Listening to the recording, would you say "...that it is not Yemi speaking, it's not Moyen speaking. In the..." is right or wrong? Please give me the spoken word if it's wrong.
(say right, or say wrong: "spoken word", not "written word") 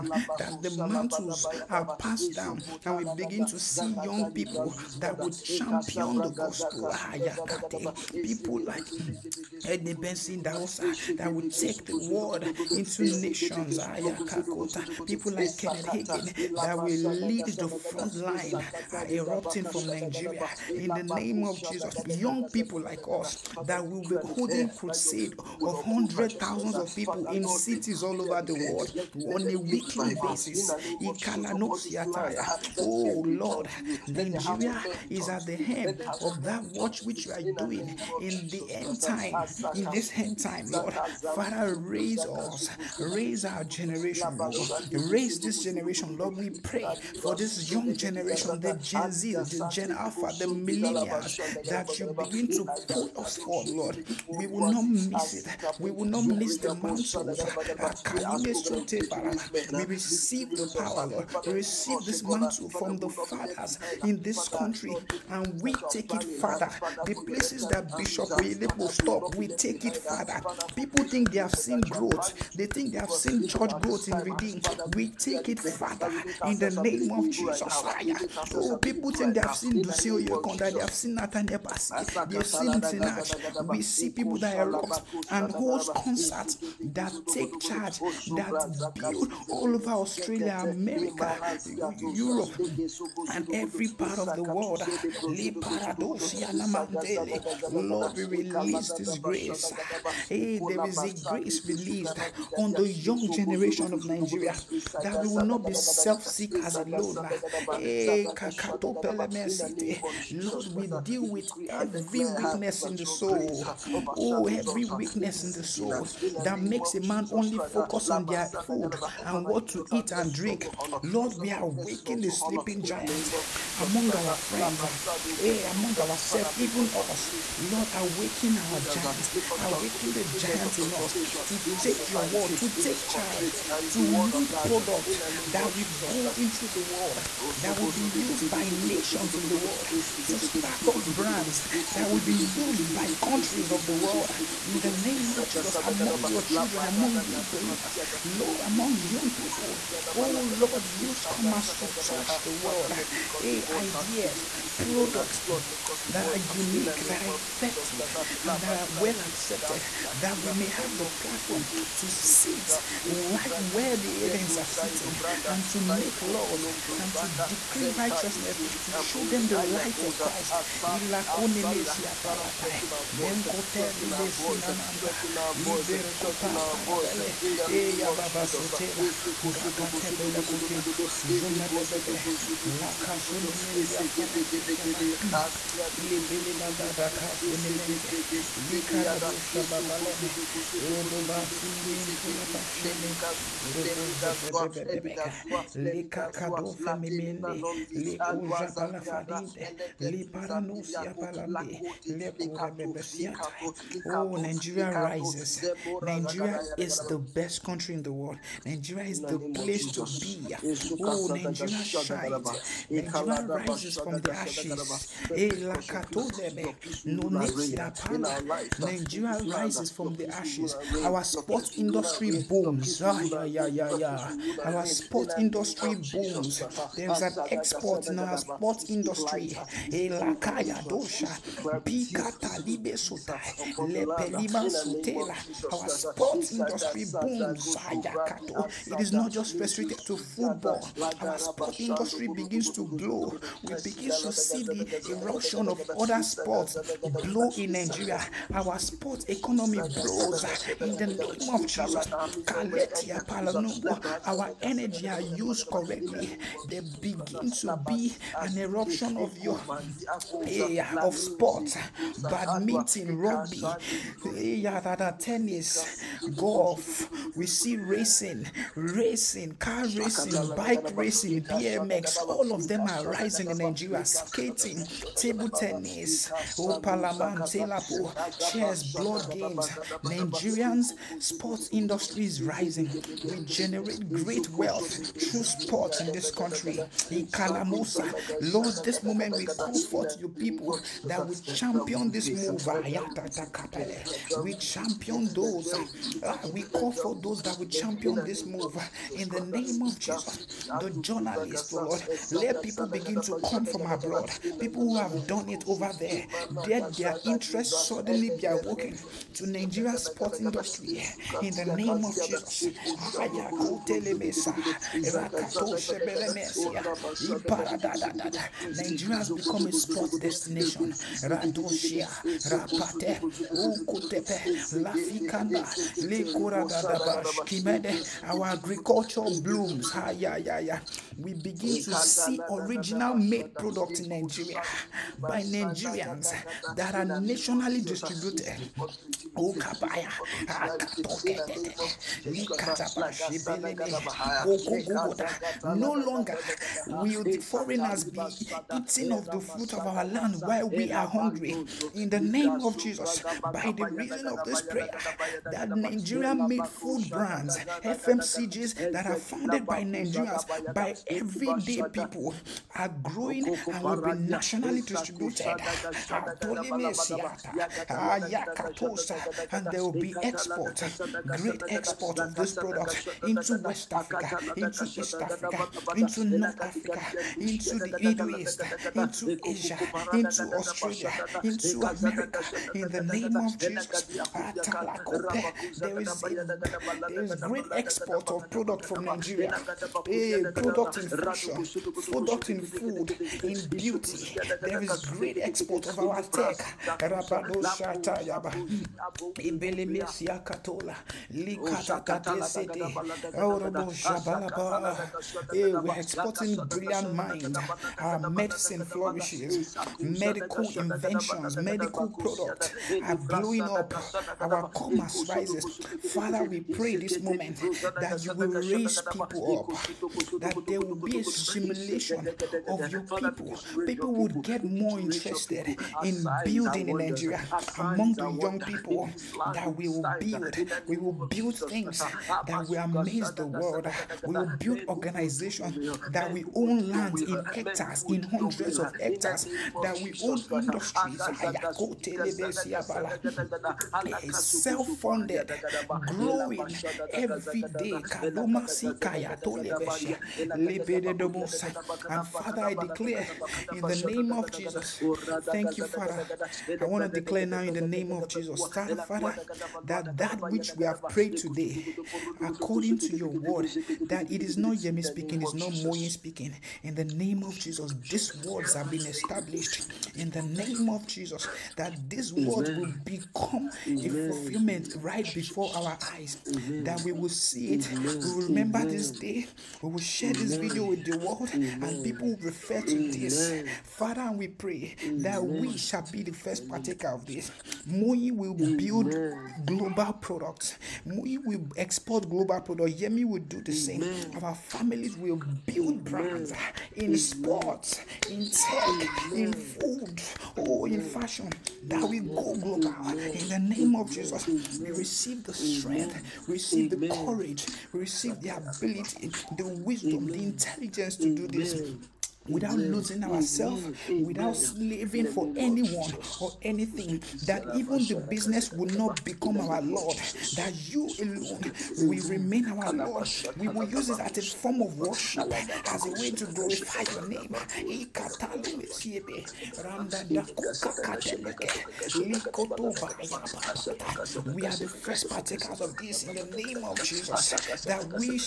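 right.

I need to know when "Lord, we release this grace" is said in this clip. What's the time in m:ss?
1:37.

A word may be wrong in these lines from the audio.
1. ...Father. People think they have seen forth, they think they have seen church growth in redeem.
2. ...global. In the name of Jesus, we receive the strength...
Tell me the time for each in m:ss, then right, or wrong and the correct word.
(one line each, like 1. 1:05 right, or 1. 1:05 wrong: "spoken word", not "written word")
1. 1:09 wrong: "growth", not "forth"
2. 8:22 right.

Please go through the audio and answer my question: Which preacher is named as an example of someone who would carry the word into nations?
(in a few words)
Benson Idahosa.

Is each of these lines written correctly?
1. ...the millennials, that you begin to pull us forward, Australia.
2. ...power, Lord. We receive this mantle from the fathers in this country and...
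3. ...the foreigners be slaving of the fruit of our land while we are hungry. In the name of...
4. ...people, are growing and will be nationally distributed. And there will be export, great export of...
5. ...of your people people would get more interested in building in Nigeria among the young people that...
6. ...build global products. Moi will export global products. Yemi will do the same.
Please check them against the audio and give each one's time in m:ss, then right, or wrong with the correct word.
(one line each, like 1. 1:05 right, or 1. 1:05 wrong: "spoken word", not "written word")
1. 0:50 wrong: "Lord", not "Australia"
2. 1:00 right
3. 5:47 wrong: "eating", not "slaving"
4. 6:01 right
5. 7:02 right
6. 8:08 right.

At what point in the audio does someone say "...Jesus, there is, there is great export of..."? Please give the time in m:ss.
6:23.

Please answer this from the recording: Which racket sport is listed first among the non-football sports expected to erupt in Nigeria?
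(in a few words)
badminton.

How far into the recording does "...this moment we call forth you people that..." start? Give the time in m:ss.
4:48.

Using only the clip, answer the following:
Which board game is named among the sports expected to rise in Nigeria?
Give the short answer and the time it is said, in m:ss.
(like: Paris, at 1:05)
chess, at 4:38.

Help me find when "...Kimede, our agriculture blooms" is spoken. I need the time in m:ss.
5:27.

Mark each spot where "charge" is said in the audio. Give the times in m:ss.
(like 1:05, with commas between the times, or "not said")
1:27, 2:13.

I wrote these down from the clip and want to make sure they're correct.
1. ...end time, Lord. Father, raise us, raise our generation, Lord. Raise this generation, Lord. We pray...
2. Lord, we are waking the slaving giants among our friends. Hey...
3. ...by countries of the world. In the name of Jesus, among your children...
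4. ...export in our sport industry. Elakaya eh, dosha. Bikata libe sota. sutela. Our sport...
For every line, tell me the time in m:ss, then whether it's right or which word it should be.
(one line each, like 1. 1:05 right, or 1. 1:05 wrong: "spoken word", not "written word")
1. 0:40 right
2. 2:01 wrong: "sleeping", not "slaving"
3. 2:22 right
4. 3:47 right.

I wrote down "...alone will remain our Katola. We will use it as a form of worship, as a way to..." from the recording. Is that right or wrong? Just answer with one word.
wrong.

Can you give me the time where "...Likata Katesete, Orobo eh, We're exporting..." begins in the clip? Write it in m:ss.
6:41.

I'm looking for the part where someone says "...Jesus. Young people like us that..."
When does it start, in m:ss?
0:21.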